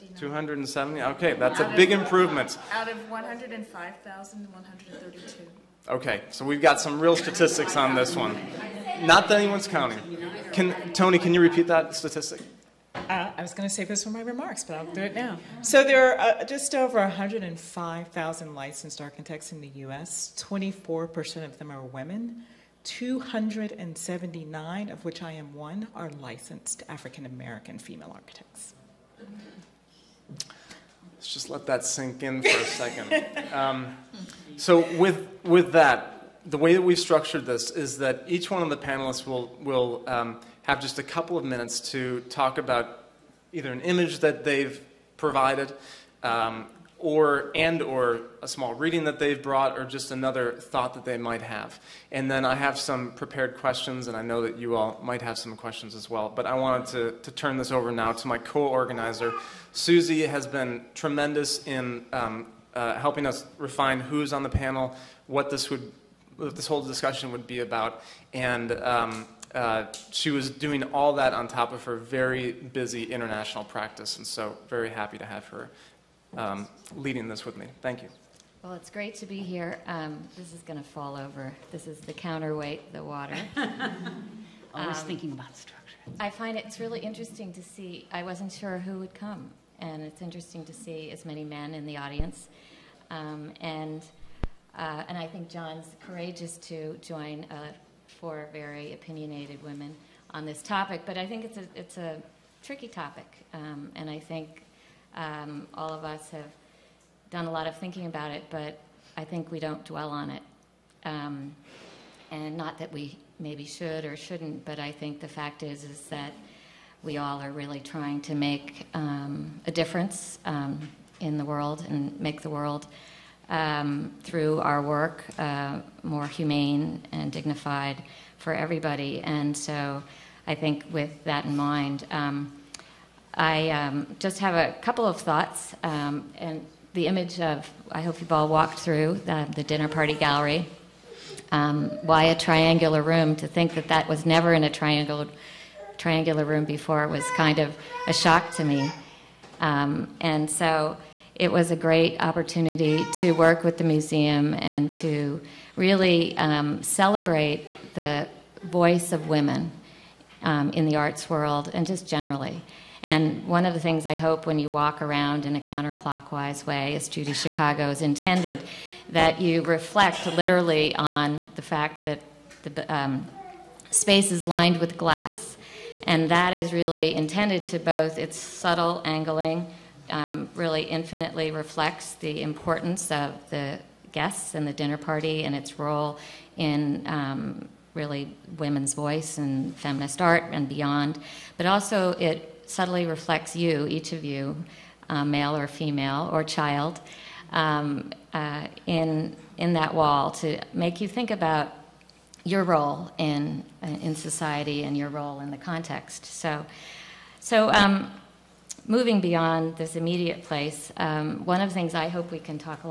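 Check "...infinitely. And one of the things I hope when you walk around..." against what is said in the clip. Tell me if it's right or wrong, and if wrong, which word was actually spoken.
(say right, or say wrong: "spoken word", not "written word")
wrong: "generally", not "infinitely".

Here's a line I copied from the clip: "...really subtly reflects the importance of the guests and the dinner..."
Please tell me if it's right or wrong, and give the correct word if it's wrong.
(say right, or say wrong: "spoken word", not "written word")
wrong: "infinitely", not "subtly".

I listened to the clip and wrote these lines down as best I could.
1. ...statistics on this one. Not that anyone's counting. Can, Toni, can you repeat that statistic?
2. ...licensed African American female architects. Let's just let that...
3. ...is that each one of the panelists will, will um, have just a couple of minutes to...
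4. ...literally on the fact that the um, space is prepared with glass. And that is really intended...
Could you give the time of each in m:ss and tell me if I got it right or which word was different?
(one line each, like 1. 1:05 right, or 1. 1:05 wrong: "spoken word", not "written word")
1. 0:07 right
2. 0:26 right
3. 0:37 right
4. 2:50 wrong: "lined", not "prepared".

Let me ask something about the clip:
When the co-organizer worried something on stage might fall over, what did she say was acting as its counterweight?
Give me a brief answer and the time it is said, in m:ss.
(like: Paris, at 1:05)
Water, at 1:22.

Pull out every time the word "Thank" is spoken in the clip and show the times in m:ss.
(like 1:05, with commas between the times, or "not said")
1:17.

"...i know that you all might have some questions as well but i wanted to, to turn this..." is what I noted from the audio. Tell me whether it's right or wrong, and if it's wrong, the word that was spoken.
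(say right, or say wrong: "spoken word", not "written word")
right.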